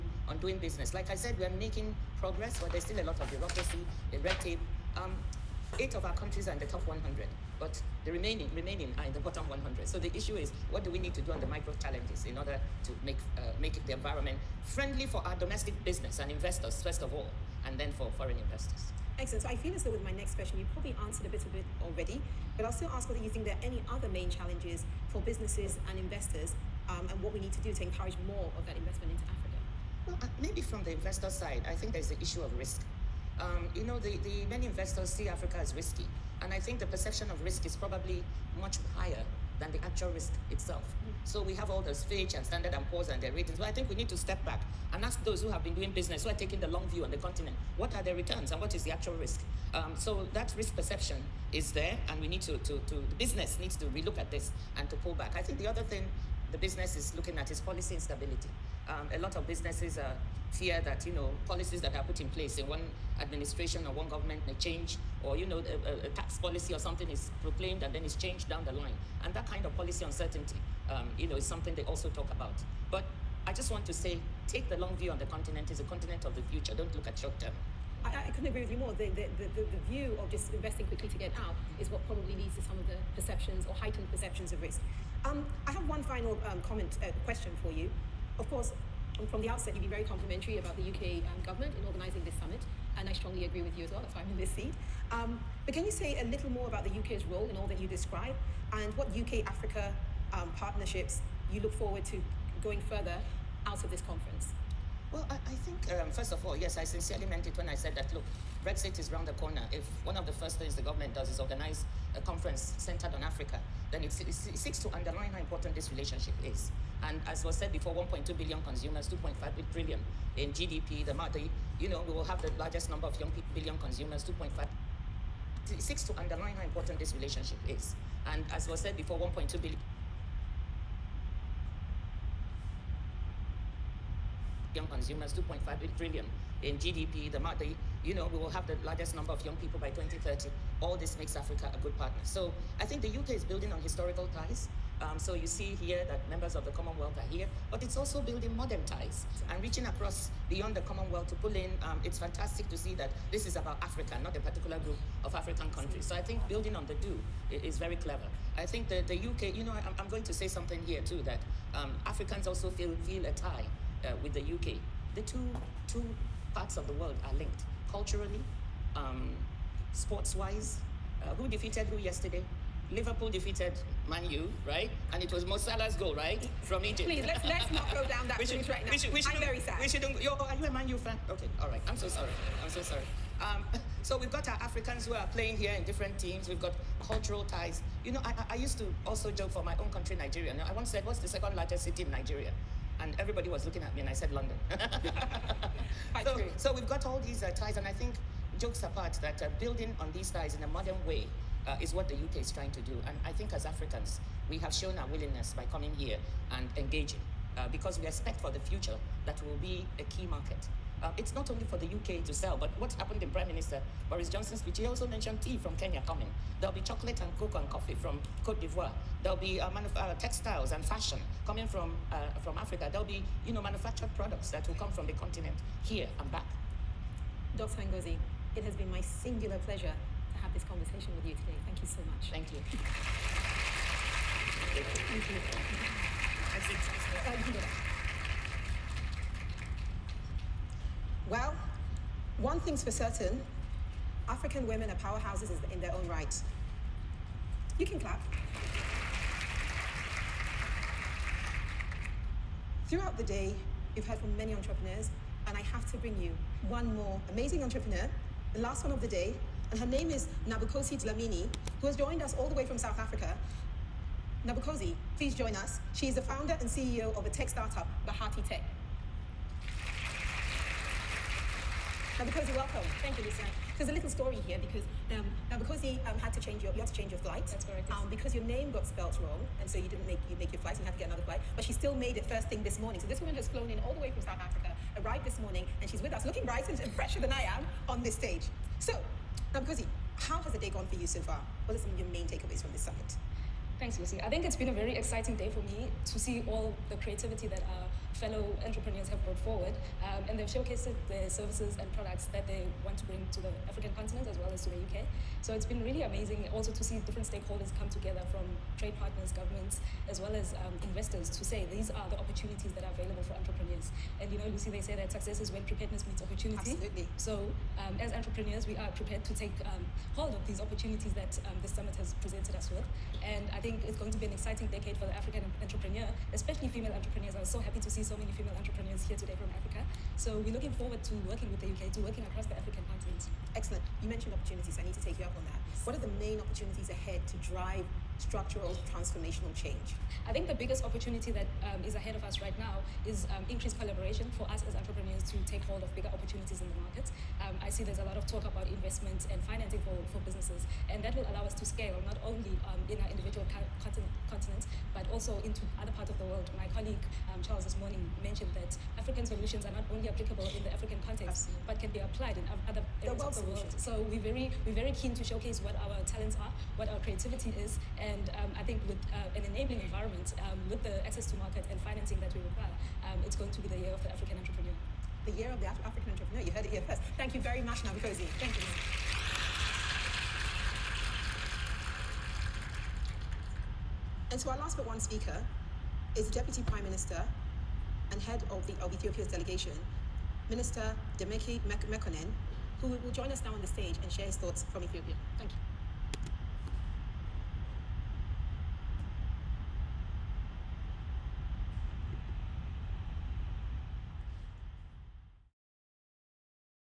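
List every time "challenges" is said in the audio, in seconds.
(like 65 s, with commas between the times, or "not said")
11 s, 24 s.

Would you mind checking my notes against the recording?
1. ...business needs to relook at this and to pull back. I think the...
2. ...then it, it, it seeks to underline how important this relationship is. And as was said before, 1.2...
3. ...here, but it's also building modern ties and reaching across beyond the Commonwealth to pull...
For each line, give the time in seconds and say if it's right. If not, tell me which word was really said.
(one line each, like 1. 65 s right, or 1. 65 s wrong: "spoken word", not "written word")
1. 53 s right
2. 113 s right
3. 147 s right.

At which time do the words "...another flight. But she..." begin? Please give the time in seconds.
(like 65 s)
281 s.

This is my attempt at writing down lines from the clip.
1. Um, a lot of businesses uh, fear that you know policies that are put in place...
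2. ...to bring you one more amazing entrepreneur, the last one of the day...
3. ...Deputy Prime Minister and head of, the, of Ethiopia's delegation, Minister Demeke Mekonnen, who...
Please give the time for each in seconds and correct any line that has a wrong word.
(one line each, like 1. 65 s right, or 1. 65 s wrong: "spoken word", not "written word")
1. 58 s right
2. 255 s right
3. 386 s right.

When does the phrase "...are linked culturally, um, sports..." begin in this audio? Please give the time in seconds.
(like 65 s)
167 s.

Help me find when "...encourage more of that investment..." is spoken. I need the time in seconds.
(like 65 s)
27 s.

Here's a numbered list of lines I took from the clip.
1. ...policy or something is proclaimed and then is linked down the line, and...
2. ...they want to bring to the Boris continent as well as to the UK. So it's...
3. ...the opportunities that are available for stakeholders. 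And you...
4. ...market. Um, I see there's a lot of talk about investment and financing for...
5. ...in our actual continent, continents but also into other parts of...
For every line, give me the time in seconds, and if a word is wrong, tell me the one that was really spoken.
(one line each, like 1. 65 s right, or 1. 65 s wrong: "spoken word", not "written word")
1. 66 s wrong: "changed", not "linked"
2. 302 s wrong: "African", not "Boris"
3. 312 s wrong: "entrepreneurs", not "stakeholders"
4. 346 s right
5. 352 s wrong: "individual", not "actual".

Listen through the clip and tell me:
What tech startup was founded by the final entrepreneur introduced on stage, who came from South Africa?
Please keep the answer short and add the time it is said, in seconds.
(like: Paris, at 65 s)
Bahati Tech, at 268 s.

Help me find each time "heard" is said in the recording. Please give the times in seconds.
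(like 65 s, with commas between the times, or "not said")
254 s, 376 s.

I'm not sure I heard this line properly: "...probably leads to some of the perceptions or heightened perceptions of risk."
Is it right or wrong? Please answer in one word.
right.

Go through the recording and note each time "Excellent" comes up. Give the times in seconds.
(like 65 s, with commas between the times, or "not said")
19 s, 333 s.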